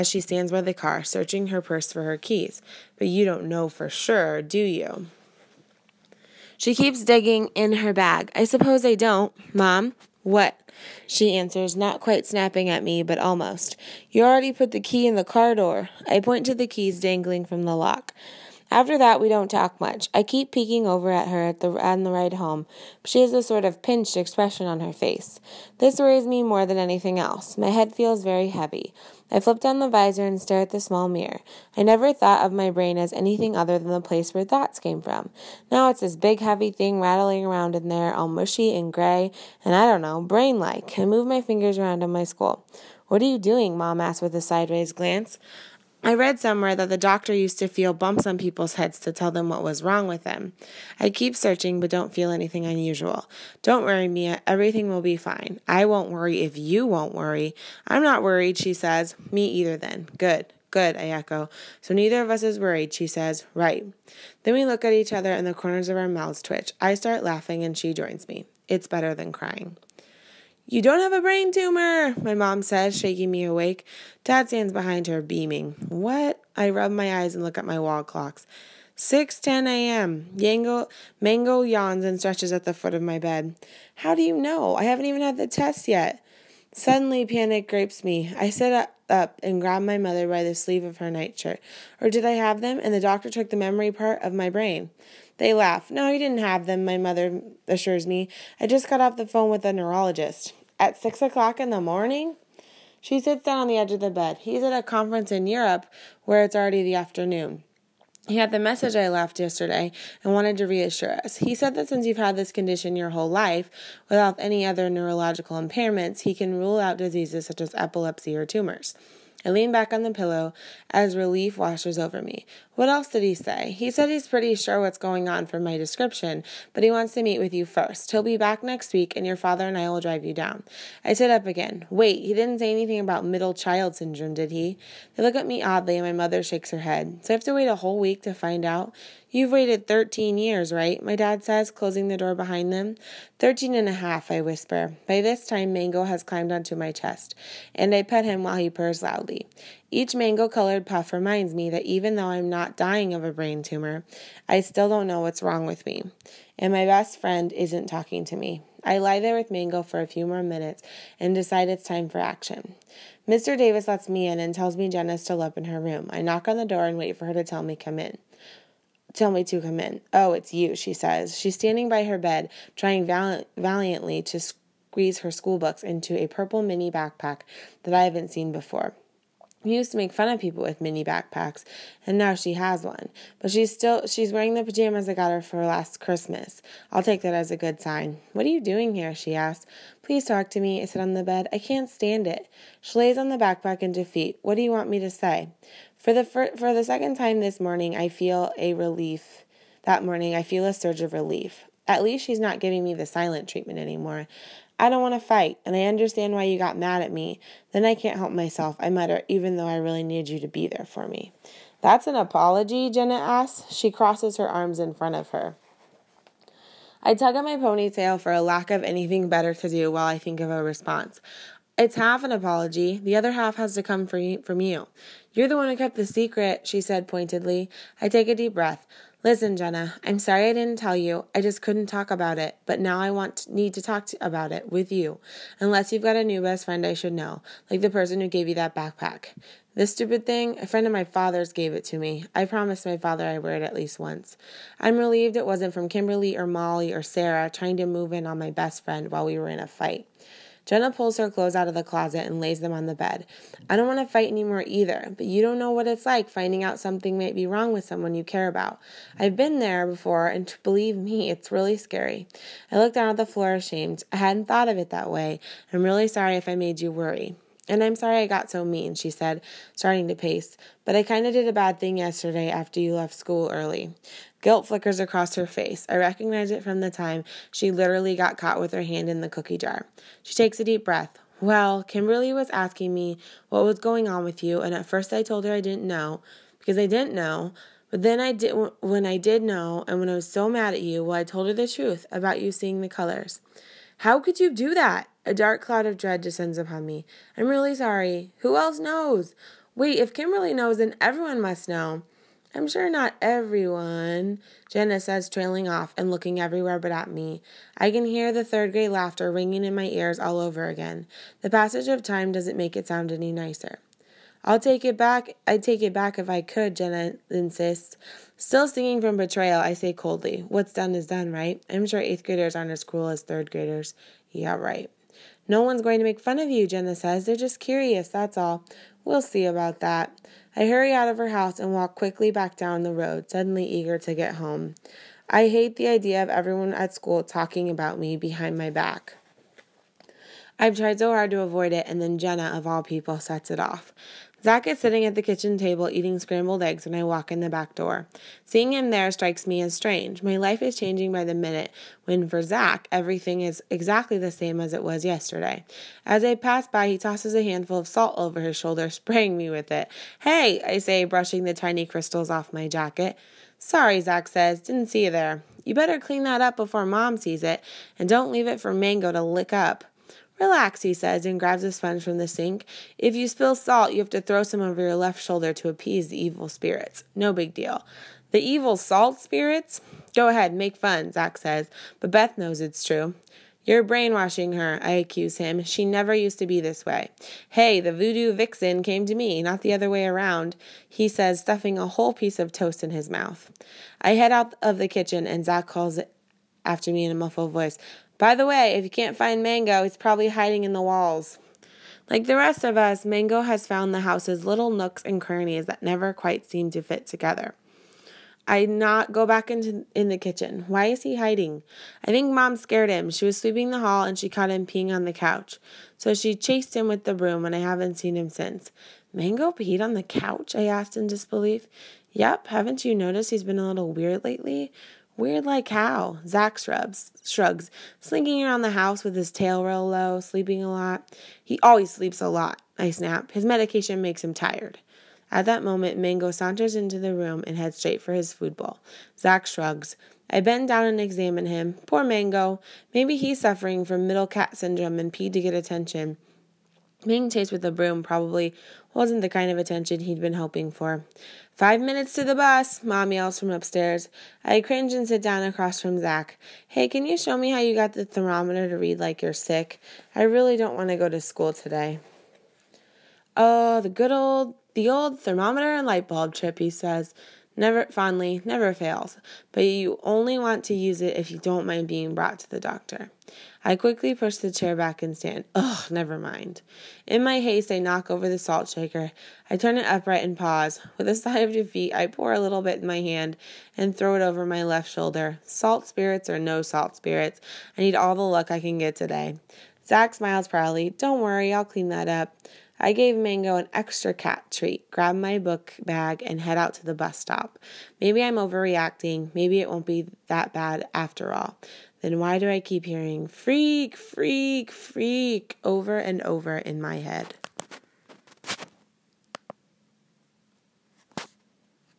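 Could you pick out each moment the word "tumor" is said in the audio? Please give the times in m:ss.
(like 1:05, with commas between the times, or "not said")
1:11, 1:58, 2:33.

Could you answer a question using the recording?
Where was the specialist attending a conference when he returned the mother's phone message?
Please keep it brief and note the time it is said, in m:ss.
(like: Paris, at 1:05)
Europe, at 1:45.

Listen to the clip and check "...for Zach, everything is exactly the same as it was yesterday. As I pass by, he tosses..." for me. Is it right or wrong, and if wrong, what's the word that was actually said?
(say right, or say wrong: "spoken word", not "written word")
right.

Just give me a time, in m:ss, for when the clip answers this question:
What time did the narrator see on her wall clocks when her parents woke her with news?
1:18.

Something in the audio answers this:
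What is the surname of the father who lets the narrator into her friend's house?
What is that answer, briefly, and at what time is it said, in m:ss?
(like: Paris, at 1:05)
Davis, at 2:43.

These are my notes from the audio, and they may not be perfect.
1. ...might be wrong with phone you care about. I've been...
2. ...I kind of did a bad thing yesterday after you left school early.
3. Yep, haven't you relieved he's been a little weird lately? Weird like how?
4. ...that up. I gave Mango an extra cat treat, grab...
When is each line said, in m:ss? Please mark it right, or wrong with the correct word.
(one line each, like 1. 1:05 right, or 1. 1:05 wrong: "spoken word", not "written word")
1. 4:17 wrong: "someone", not "phone"
2. 4:30 right
3. 7:02 wrong: "noticed", not "relieved"
4. 8:11 right.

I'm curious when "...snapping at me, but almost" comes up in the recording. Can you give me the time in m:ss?
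0:12.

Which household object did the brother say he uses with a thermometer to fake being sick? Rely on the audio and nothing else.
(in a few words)
light bulb.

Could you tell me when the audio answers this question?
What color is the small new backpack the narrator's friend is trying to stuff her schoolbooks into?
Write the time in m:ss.
2:56.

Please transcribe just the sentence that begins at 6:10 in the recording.
Relax, he says, and grabs a sponge from the sink.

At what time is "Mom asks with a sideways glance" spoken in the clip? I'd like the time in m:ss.
0:43.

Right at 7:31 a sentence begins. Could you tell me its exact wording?
Five minutes to the bus, Mom yells from upstairs.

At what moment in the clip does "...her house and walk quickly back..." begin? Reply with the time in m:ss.
5:31.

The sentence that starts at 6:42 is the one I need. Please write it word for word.
Like the rest of us, Mango has found the house's little nooks and crannies that never quite seem to fit together.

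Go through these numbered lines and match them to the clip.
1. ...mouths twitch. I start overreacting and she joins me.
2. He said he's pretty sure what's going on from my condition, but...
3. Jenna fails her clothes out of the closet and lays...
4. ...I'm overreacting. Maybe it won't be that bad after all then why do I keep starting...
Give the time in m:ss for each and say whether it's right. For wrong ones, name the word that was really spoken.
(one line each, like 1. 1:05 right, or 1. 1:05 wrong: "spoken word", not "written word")
1. 1:06 wrong: "laughing", not "overreacting"
2. 2:03 wrong: "description", not "condition"
3. 4:10 wrong: "pulls", not "fails"
4. 8:18 wrong: "hearing", not "starting".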